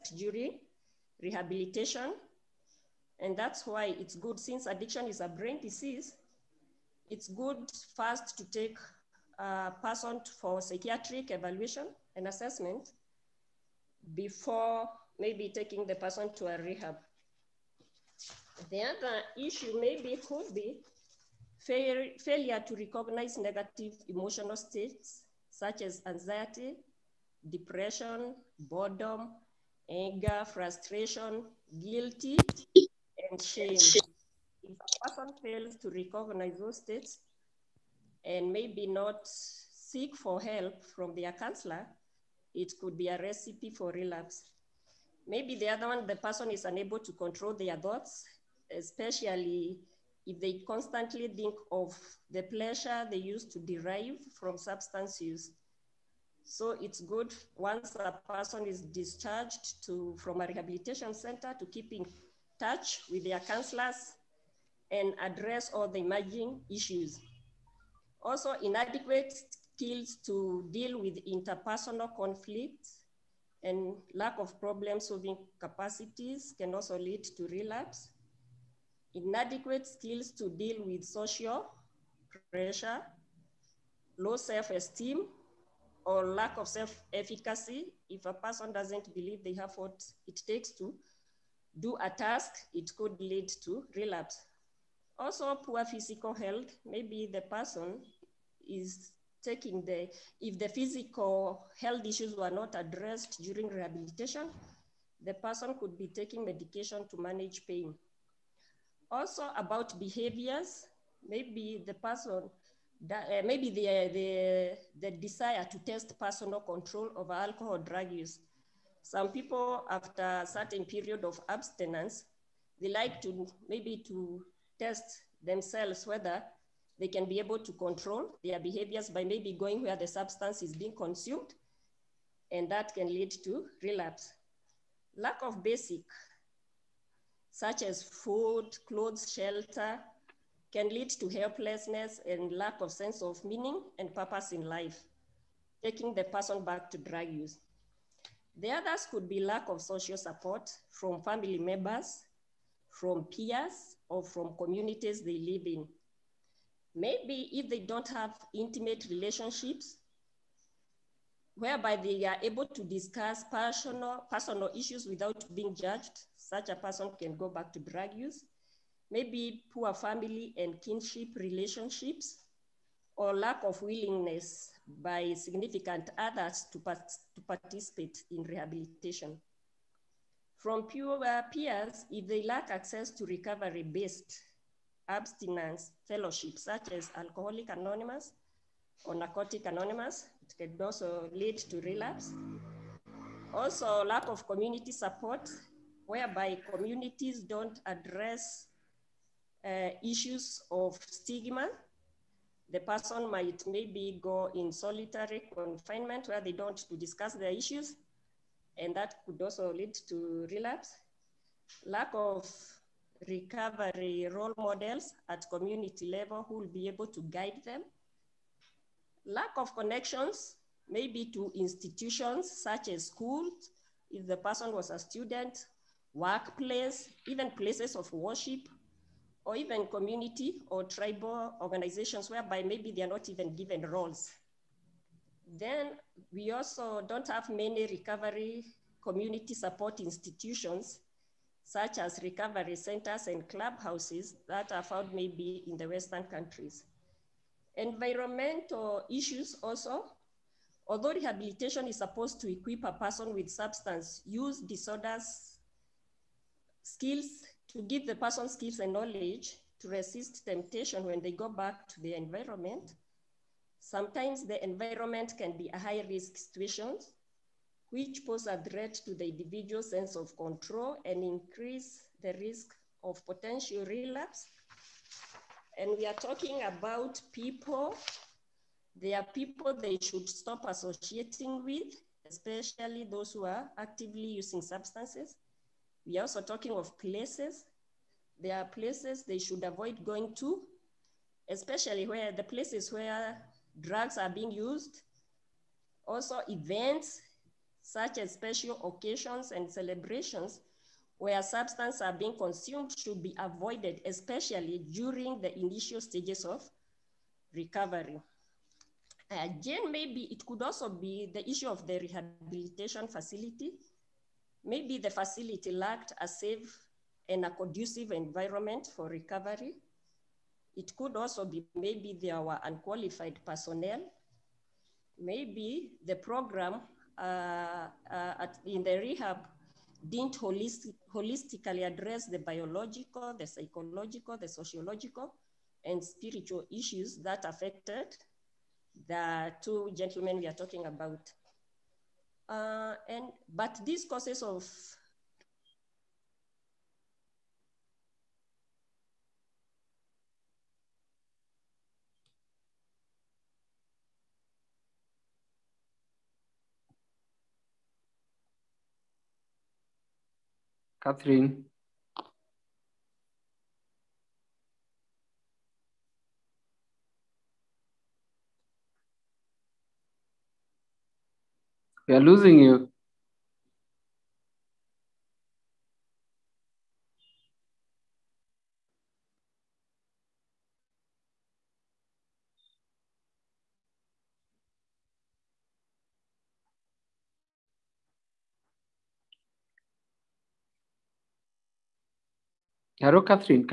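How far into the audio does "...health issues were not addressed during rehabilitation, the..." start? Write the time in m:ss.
1:41.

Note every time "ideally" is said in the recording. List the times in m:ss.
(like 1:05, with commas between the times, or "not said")
not said.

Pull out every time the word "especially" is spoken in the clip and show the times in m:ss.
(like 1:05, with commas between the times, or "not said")
0:48, 4:42, 4:51, 5:04.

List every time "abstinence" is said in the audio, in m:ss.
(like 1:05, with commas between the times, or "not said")
2:01, 3:05.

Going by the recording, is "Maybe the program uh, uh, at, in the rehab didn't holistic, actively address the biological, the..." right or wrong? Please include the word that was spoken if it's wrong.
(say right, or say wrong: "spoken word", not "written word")
wrong: "holistically", not "actively".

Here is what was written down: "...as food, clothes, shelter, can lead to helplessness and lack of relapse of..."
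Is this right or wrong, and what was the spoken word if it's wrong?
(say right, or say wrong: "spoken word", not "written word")
wrong: "sense", not "relapse".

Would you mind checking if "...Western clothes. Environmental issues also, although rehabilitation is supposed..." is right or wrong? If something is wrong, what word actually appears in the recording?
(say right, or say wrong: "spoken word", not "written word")
wrong: "countries", not "clothes".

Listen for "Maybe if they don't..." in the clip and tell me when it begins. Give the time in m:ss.
2:36.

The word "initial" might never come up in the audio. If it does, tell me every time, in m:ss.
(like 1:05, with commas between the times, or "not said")
5:05.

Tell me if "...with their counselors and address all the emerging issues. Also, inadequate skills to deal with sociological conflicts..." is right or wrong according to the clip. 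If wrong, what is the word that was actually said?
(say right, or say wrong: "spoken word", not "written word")
wrong: "interpersonal", not "sociological".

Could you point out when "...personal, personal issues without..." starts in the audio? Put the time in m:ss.
2:43.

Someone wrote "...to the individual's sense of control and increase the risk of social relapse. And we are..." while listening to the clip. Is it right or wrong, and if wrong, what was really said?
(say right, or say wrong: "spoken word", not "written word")
wrong: "potential", not "social".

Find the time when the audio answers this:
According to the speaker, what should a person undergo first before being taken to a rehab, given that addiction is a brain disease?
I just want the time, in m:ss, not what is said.
0:10.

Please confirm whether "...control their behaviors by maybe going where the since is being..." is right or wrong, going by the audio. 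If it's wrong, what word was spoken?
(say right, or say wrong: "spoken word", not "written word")
wrong: "substance", not "since".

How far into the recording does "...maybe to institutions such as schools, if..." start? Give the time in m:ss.
3:40.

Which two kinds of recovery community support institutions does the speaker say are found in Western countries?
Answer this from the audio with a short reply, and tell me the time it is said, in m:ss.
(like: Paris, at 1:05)
Recovery centers and clubhouses, at 4:02.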